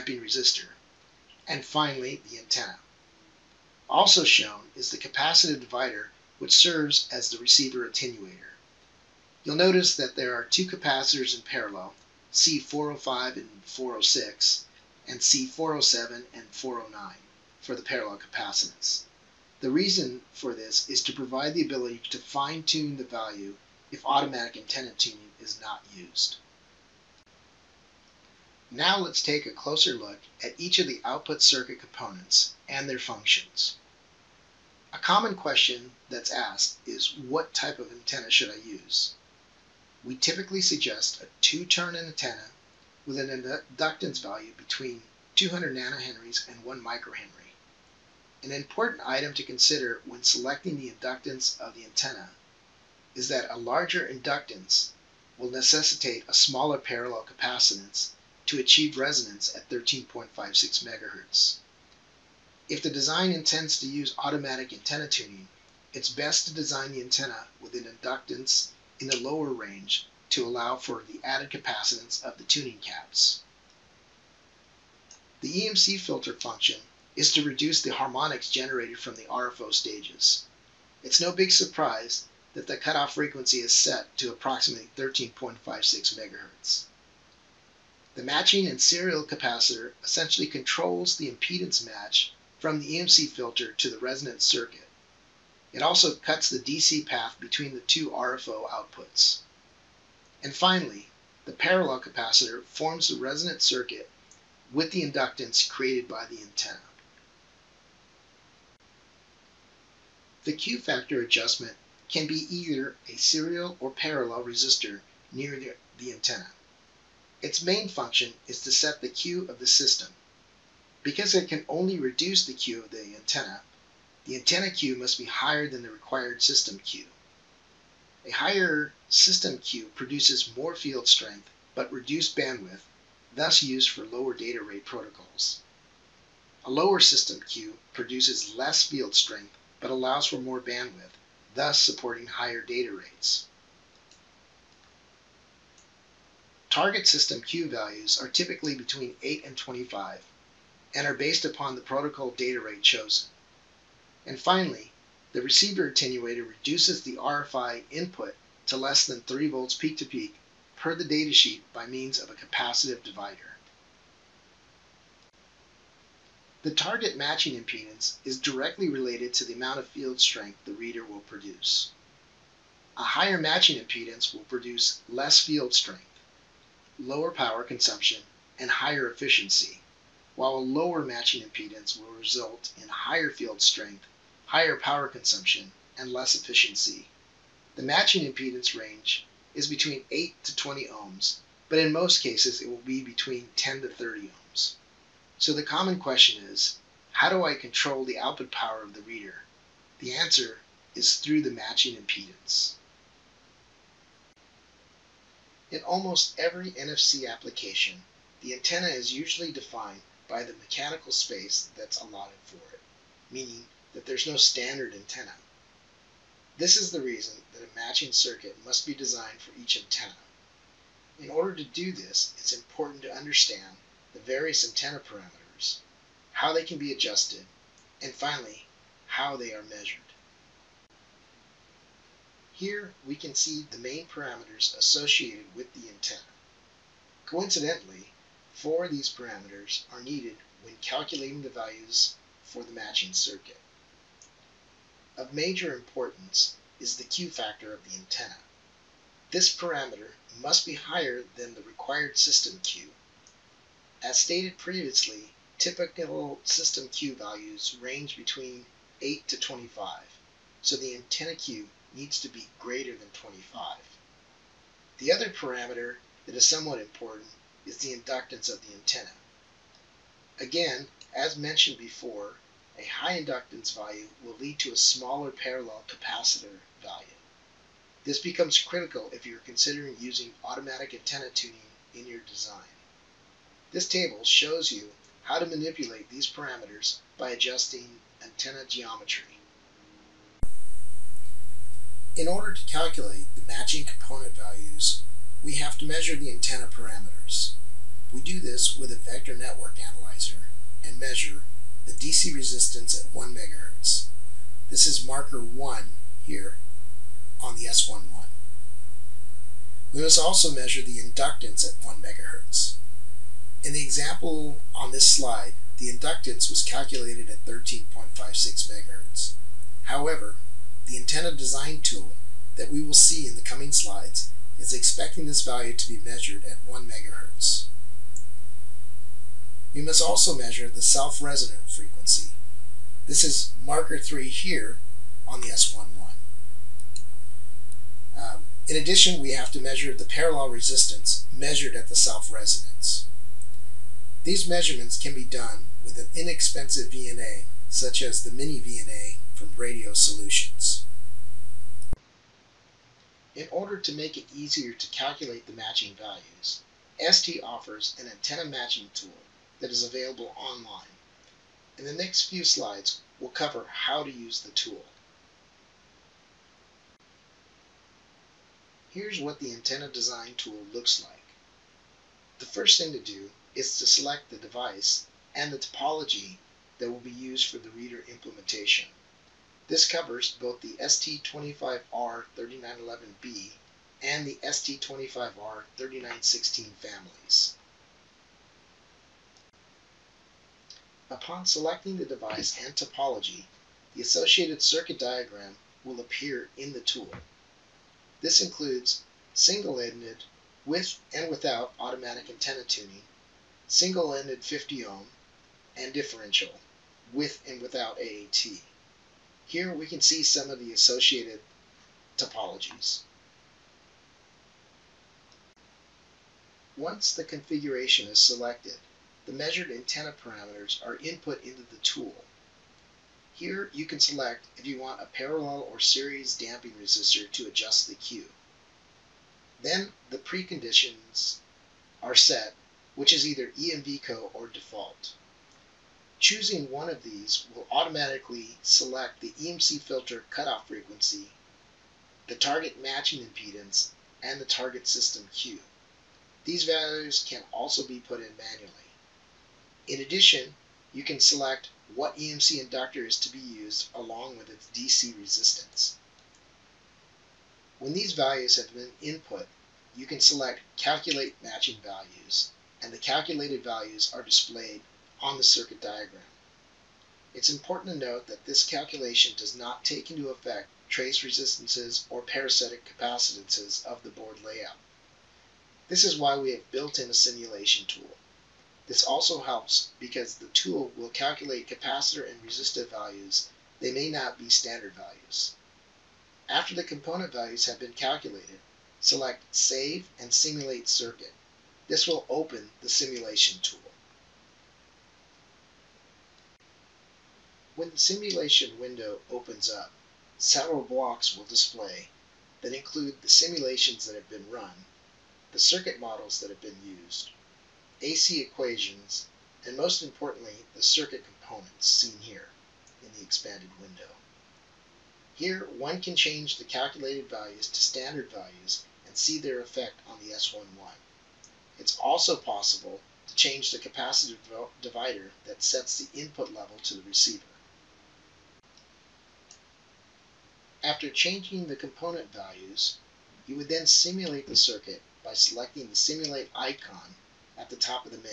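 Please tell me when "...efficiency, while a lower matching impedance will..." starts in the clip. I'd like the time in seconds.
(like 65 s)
179 s.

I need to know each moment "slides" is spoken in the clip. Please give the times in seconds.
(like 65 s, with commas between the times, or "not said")
315 s, 323 s, 362 s.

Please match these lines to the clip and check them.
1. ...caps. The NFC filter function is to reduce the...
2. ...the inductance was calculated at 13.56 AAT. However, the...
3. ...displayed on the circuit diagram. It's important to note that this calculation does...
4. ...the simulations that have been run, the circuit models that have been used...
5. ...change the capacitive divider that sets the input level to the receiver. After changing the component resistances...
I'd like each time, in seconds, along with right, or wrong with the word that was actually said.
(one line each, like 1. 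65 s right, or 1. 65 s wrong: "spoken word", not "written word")
1. 72 s wrong: "EMC", not "NFC"
2. 315 s wrong: "MHz", not "AAT"
3. 464 s right
4. 503 s right
5. 523 s wrong: "values", not "resistances".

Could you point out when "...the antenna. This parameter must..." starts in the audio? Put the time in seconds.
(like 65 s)
247 s.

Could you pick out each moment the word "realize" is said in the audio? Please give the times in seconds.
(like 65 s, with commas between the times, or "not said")
not said.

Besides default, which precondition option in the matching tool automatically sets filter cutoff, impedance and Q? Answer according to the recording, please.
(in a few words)
EMVCO.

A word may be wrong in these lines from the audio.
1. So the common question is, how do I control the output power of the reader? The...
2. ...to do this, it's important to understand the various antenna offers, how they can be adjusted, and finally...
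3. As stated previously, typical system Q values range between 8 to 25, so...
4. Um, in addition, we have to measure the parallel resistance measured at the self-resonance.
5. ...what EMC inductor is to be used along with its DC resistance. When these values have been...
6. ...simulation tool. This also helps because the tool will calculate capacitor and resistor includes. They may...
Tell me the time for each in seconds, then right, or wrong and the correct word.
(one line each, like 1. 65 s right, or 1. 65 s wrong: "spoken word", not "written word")
1. 195 s right
2. 221 s wrong: "parameters", not "offers"
3. 254 s right
4. 338 s right
5. 451 s right
6. 477 s wrong: "values", not "includes".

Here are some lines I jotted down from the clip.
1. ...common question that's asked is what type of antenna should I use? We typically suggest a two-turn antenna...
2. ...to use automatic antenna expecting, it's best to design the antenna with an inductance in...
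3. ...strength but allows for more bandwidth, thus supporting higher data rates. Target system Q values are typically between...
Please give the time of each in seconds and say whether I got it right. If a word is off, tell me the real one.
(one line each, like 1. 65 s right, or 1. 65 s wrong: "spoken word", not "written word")
1. 34 s right
2. 63 s wrong: "tuning", not "expecting"
3. 139 s right.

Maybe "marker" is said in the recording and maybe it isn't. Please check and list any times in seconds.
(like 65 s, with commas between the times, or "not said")
305 s, 333 s.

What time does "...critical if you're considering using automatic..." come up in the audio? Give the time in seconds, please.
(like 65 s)
278 s.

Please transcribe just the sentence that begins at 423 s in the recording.
Here you can select if you want a parallel or series damping resistor to adjust the Q.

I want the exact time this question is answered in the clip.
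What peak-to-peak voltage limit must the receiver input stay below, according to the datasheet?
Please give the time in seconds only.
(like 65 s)
159 s.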